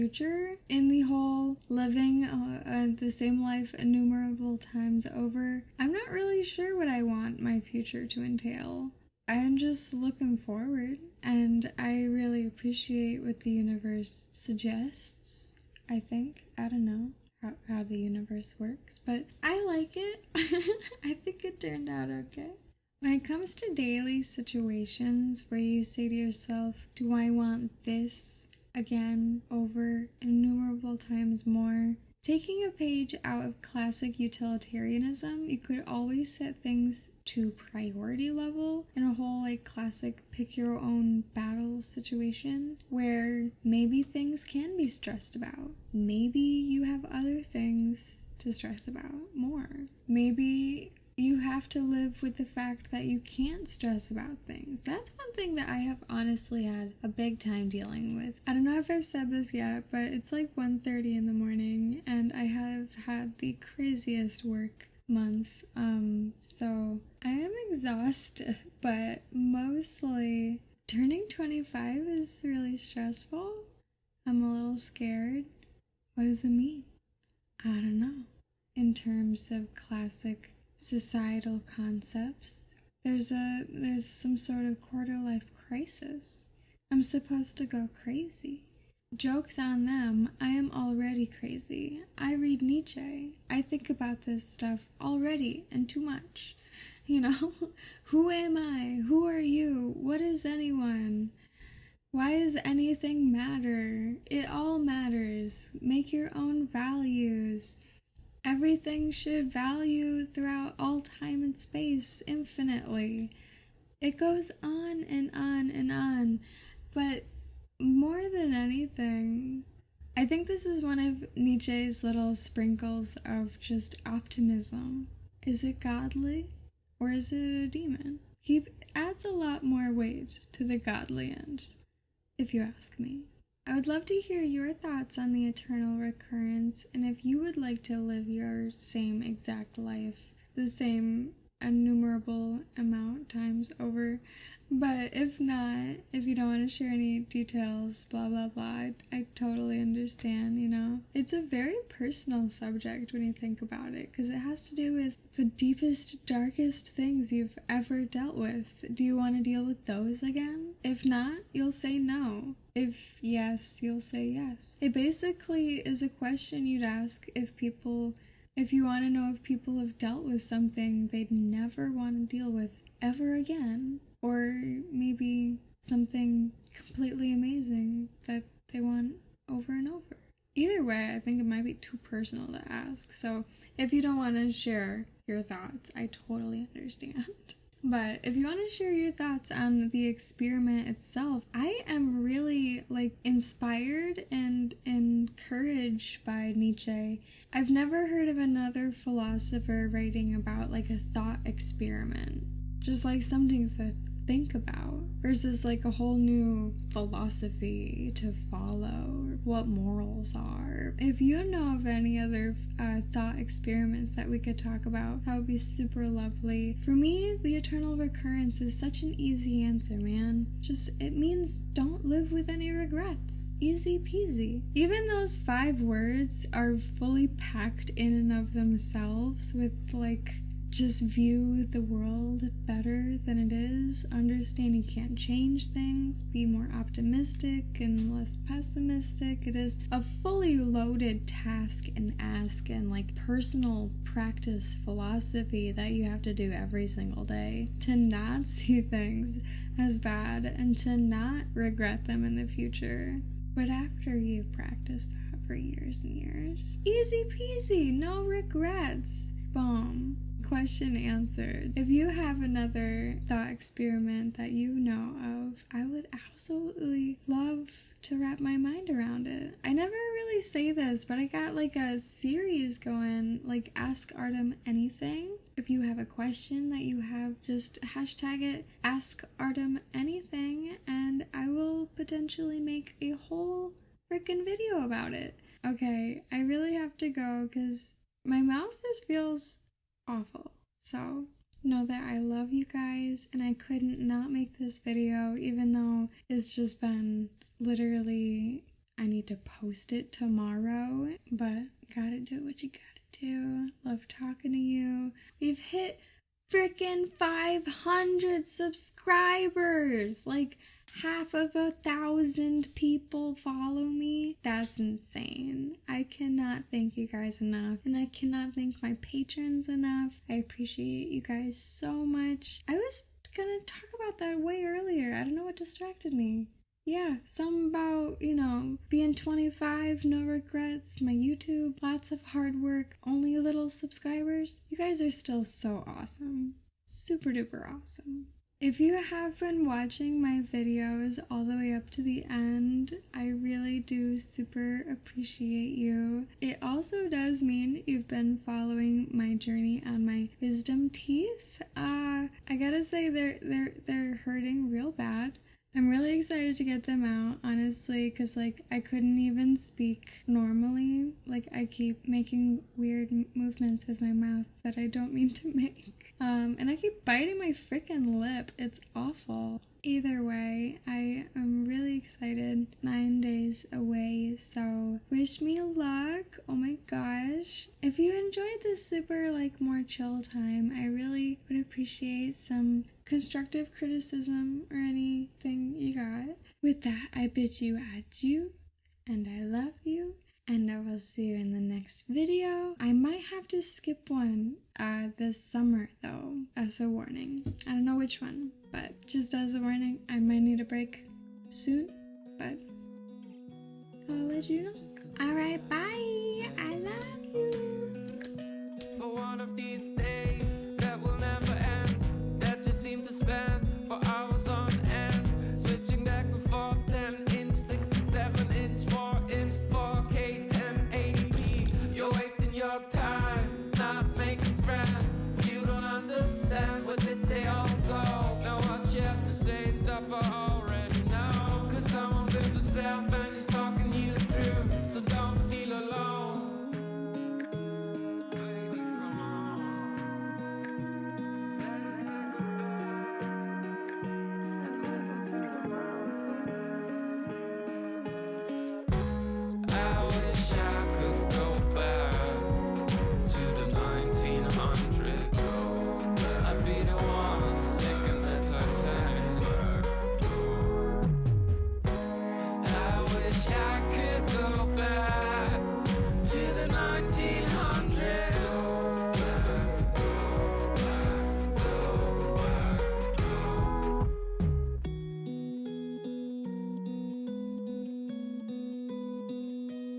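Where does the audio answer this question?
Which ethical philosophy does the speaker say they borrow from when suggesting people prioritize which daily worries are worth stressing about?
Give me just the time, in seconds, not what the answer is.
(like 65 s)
33 s.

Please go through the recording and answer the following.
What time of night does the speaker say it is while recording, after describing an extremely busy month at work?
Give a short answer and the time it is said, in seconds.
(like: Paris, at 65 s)
1:30 in the morning, at 60 s.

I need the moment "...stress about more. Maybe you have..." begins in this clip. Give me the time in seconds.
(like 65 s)
48 s.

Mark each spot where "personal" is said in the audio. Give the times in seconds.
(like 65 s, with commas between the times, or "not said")
151 s, 181 s, 243 s.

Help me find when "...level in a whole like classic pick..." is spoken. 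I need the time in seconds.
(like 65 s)
38 s.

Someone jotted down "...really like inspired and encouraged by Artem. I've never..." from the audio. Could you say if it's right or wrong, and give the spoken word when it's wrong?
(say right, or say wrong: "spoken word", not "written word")
wrong: "Nietzsche", not "Artem".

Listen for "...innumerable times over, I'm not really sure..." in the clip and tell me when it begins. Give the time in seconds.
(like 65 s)
3 s.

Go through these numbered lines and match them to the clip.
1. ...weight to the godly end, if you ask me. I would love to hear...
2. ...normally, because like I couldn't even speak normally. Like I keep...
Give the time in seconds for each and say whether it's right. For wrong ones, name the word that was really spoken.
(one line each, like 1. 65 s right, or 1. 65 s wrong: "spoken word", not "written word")
1. 129 s right
2. 357 s wrong: "honestly", not "normally".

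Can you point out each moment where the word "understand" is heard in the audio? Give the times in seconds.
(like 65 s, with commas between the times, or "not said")
149 s, 186 s, 234 s.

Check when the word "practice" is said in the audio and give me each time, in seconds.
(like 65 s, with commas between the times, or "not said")
244 s, 254 s.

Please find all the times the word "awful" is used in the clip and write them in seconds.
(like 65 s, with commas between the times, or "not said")
290 s, 368 s.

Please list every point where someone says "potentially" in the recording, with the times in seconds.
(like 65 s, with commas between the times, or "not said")
281 s.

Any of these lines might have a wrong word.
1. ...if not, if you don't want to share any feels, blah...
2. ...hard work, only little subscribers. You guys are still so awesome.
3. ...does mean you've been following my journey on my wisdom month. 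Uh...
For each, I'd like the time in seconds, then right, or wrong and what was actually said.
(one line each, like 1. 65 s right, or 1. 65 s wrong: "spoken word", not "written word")
1. 145 s wrong: "details", not "feels"
2. 332 s right
3. 347 s wrong: "teeth", not "month".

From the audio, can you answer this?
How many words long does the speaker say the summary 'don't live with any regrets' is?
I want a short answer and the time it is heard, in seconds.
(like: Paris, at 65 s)
5, at 225 s.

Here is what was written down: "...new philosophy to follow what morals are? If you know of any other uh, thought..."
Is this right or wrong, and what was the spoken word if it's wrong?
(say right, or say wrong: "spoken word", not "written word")
right.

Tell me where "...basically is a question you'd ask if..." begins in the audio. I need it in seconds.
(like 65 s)
164 s.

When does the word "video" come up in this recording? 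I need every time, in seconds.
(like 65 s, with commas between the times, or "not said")
284 s, 294 s, 340 s, 392 s.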